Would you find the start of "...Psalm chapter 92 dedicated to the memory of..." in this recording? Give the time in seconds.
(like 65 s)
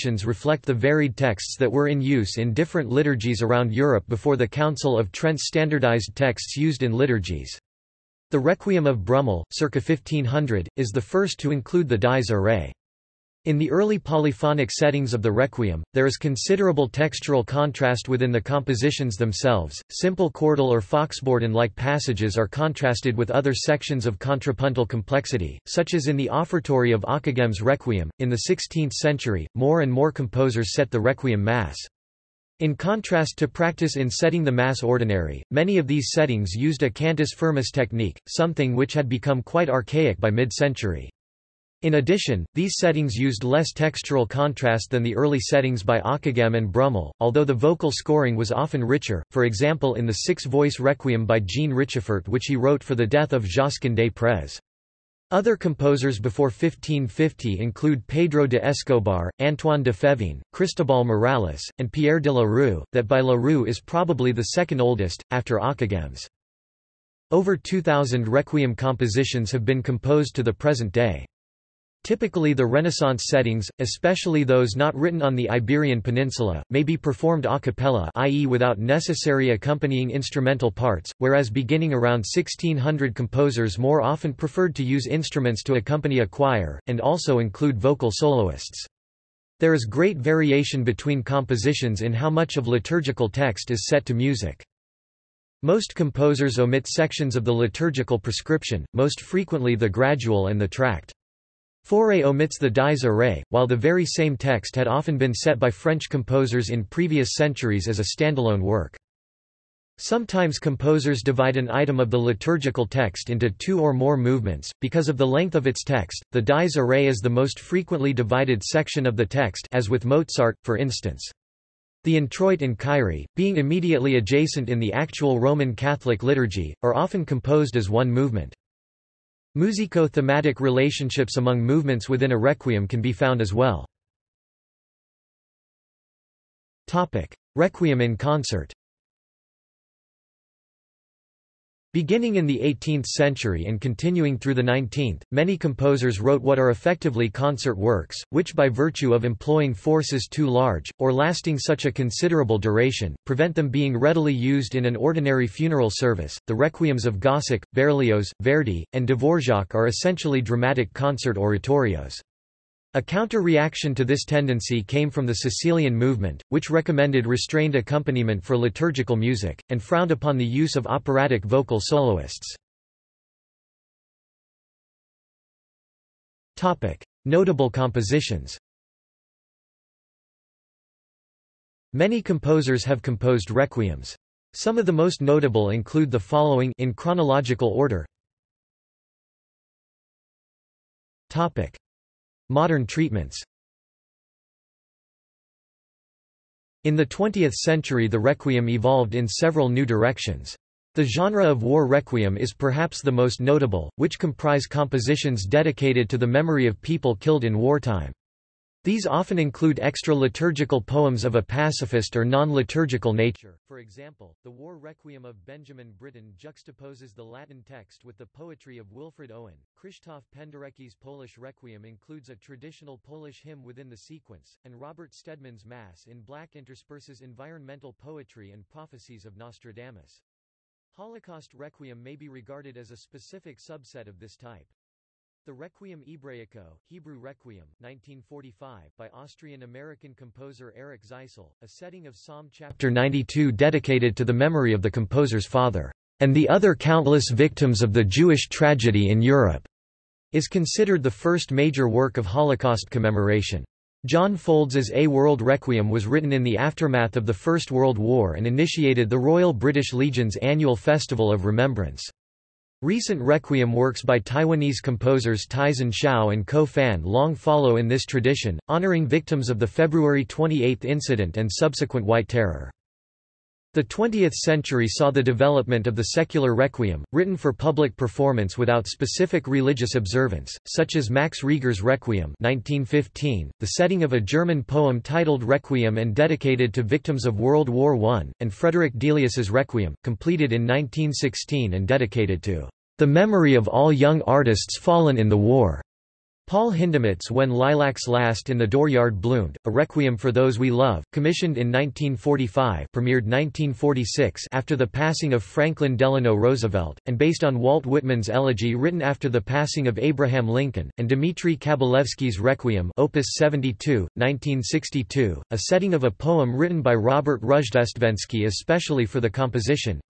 242 s.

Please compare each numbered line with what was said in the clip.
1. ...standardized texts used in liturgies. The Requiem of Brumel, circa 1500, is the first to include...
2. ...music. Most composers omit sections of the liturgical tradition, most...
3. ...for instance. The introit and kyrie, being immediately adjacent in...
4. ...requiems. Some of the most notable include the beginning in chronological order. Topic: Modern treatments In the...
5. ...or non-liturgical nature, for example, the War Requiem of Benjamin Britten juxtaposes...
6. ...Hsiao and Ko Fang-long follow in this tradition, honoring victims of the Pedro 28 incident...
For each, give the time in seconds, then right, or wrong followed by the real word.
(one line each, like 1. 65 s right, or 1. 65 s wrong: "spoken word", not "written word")
1. 5 s right
2. 94 s wrong: "prescription", not "tradition"
3. 120 s right
4. 183 s wrong: "following", not "beginning"
5. 212 s right
6. 265 s wrong: "February", not "Pedro".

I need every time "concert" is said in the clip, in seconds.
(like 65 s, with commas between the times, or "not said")
138 s, 147 s, 160 s.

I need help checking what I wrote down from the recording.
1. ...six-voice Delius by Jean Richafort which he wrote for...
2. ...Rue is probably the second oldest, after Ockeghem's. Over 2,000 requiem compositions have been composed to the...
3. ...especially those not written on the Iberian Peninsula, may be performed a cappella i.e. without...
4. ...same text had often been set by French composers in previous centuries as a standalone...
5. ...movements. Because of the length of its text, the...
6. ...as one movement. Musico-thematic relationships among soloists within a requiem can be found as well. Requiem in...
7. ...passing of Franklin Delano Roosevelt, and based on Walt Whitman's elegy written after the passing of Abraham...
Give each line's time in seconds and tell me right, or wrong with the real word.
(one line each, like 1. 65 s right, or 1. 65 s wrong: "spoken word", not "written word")
1. 50 s wrong: "Requiem", not "Delius"
2. 63 s right
3. 73 s right
4. 104 s right
5. 114 s right
6. 127 s wrong: "movements", not "soloists"
7. 304 s right.